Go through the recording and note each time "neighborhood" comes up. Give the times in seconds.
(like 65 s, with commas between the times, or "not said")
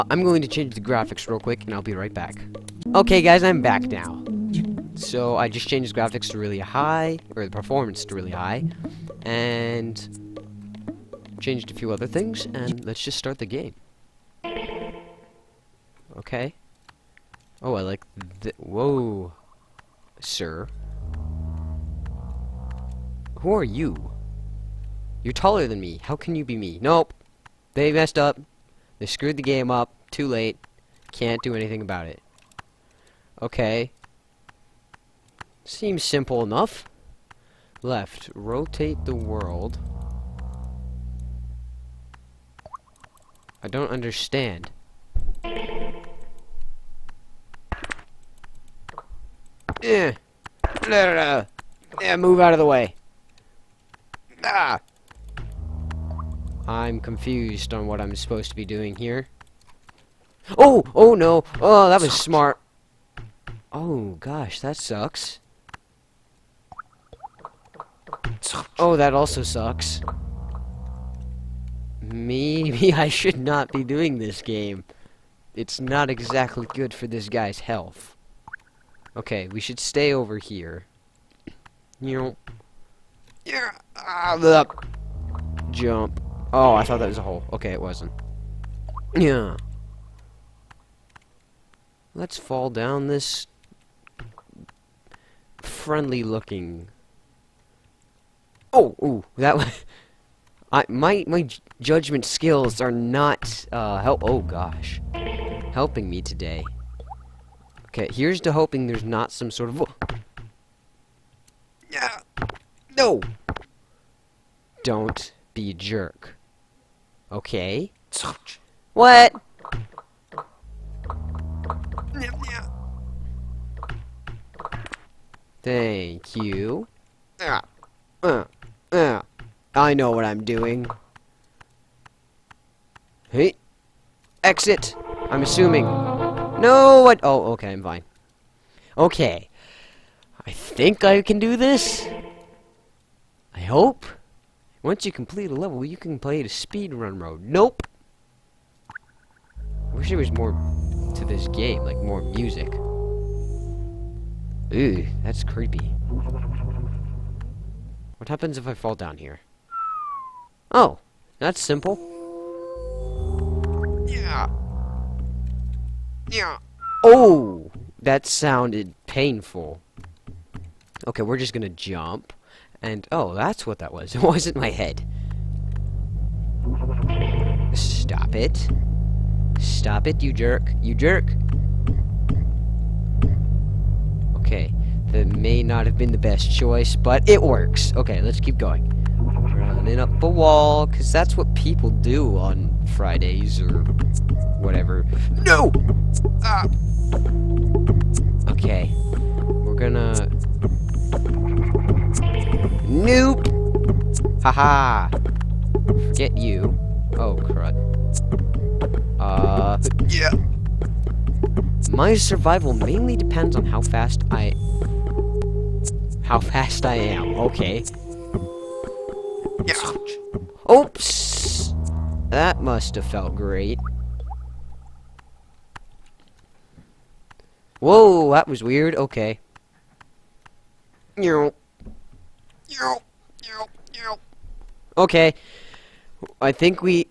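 not said.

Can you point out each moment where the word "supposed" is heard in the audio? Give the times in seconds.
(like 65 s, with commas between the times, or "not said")
58 s.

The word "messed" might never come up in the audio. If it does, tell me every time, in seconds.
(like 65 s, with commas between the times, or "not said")
27 s.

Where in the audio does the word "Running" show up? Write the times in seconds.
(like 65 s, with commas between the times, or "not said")
189 s.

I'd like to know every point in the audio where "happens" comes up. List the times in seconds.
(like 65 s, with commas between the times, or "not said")
158 s.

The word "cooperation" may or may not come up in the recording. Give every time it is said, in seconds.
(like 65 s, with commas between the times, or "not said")
not said.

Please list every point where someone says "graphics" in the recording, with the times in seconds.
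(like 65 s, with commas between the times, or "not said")
0 s, 6 s.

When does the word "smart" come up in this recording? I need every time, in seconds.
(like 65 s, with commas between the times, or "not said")
62 s.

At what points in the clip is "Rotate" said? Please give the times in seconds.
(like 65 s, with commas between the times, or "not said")
38 s.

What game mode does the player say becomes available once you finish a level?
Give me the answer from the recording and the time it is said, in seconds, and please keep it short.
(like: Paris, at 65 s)
speedrun mode, at 146 s.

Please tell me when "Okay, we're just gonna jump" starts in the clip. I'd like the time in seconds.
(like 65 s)
171 s.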